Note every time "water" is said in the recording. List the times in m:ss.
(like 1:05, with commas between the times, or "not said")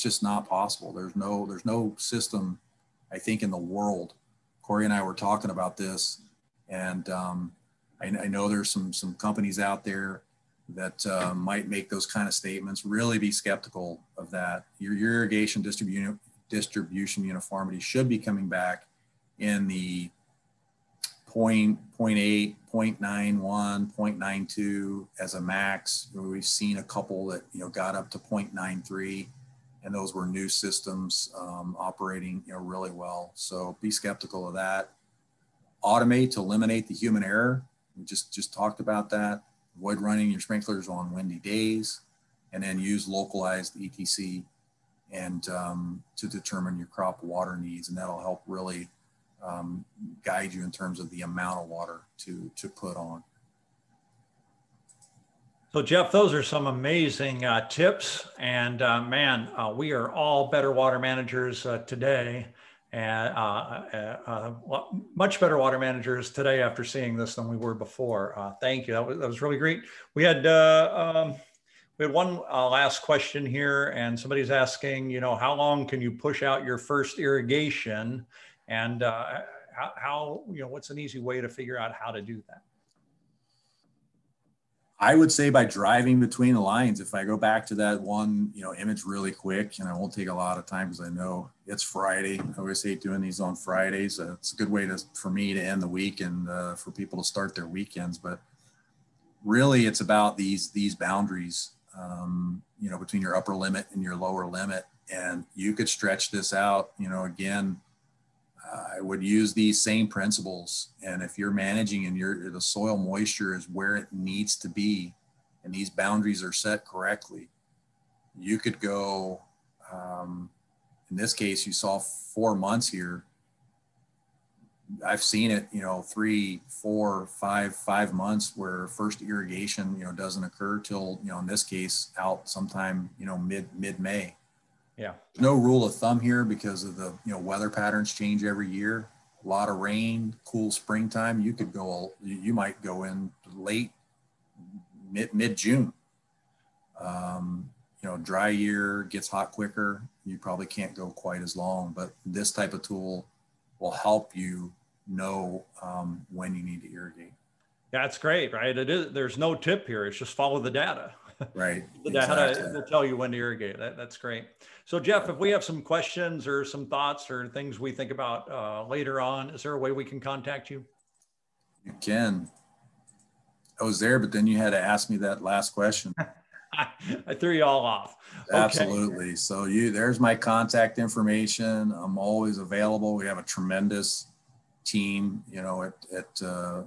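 0:47, 0:51, 1:00, 1:05.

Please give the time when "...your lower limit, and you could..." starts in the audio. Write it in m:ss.
1:44.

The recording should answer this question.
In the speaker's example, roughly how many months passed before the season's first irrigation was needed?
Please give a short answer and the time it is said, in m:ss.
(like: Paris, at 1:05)
4 months, at 2:01.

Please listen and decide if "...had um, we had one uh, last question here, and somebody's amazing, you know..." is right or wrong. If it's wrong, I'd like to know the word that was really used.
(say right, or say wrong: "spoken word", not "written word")
wrong: "asking", not "amazing".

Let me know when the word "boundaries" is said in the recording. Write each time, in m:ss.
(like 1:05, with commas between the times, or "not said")
1:40, 1:55.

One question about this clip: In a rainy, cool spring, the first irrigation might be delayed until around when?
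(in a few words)
Mid June.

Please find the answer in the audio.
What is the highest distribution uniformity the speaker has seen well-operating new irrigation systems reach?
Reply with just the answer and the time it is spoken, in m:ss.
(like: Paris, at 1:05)
0.93, at 0:28.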